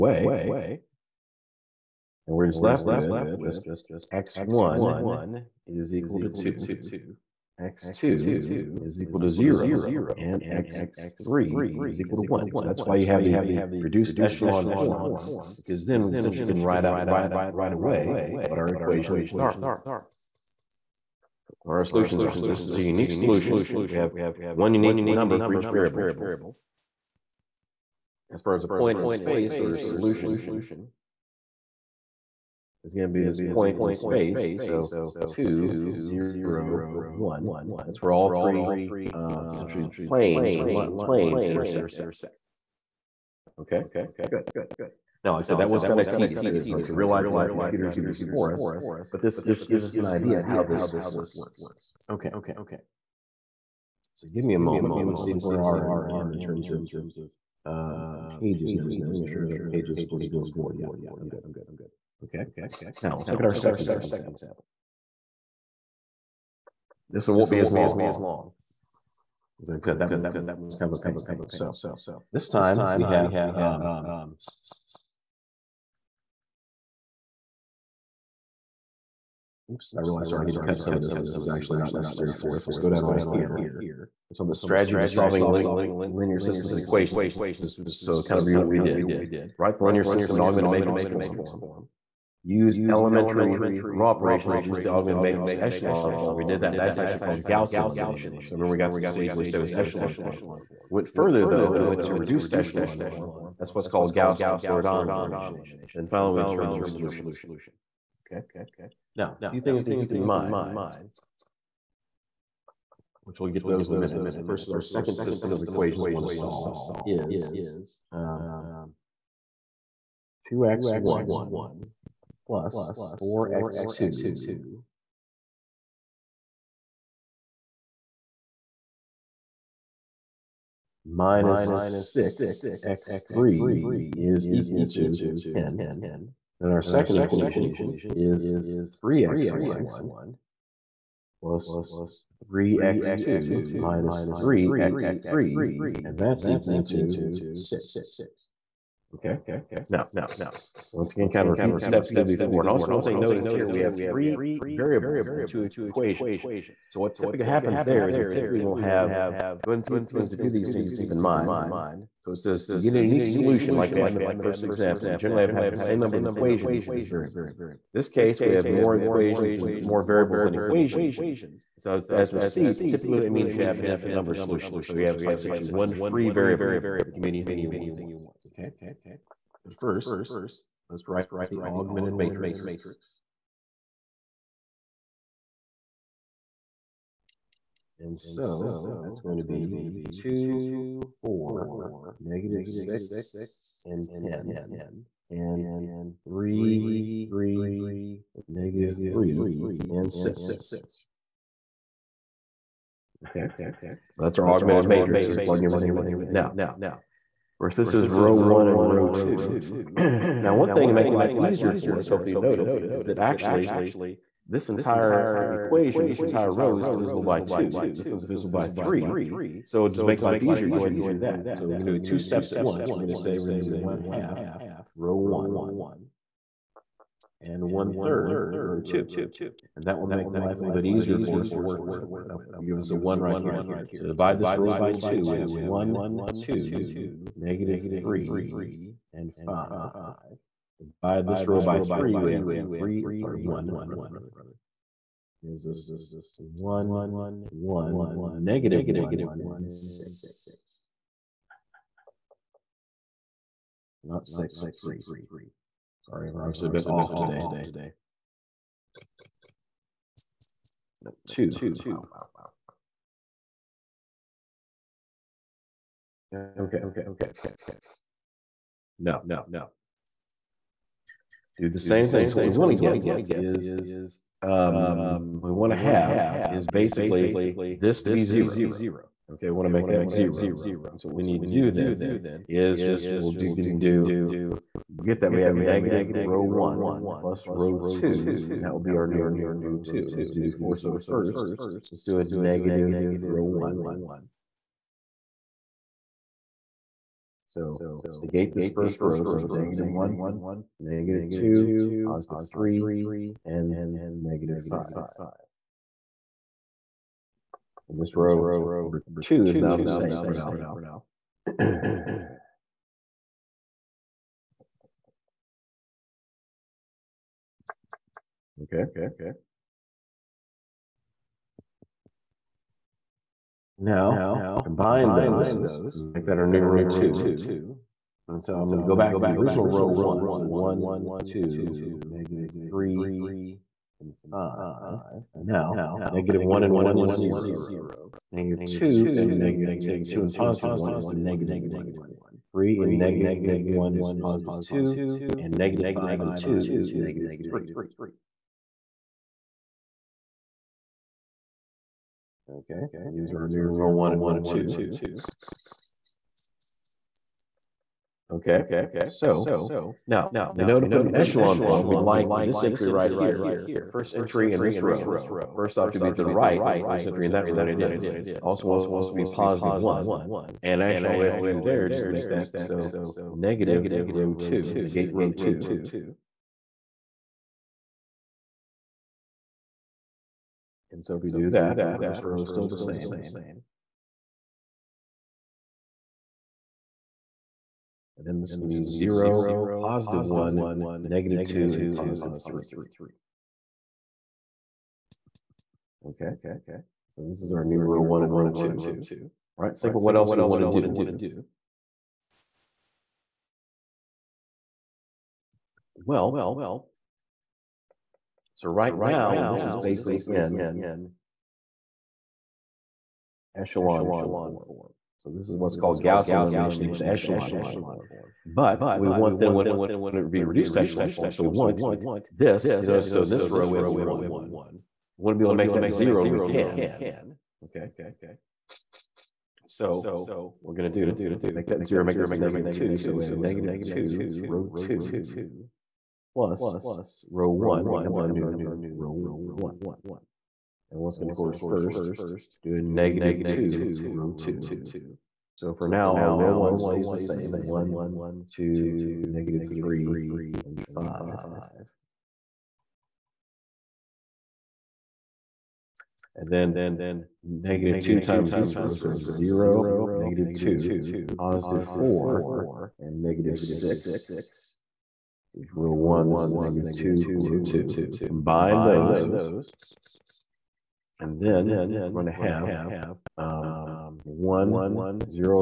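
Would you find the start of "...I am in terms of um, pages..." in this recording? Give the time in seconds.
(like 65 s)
55 s.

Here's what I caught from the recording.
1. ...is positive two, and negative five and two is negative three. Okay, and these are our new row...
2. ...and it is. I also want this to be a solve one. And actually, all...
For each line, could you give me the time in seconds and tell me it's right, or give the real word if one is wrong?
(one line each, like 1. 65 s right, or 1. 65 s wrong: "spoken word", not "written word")
1. 343 s right
2. 367 s wrong: "positive", not "solve".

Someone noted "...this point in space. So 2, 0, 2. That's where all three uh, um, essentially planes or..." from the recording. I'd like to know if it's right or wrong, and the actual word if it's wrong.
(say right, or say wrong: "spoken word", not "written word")
wrong: "1", not "2".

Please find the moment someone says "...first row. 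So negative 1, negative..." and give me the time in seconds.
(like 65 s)
298 s.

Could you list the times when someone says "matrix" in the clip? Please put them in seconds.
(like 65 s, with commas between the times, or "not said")
90 s, 95 s, 182 s, 204 s.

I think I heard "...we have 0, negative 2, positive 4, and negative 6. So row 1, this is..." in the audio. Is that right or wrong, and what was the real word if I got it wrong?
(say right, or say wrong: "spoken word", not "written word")
right.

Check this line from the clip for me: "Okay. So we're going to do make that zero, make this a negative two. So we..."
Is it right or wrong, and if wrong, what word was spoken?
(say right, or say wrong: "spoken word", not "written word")
right.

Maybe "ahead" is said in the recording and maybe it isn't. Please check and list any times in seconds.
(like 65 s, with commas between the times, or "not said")
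159 s, 220 s.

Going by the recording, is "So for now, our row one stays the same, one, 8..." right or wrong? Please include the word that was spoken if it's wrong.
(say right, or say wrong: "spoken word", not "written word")
wrong: "2", not "8".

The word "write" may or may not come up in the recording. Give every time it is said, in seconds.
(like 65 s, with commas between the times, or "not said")
16 s, 89 s, 181 s.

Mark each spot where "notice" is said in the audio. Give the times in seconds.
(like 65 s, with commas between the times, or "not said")
153 s, 212 s.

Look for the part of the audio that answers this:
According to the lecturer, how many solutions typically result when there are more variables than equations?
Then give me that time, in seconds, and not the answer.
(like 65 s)
173 s.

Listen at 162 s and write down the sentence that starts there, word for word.
So it says you get a unique solution like we had in the first example.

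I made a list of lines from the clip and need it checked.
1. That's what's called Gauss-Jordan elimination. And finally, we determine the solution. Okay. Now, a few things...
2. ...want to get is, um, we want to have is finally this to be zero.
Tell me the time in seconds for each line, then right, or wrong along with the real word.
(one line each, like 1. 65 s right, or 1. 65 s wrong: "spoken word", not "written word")
1. 103 s right
2. 272 s wrong: "basically", not "finally".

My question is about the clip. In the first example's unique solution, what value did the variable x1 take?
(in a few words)
2.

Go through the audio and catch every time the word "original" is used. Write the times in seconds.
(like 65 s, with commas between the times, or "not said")
329 s.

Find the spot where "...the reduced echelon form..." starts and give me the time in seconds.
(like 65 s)
13 s.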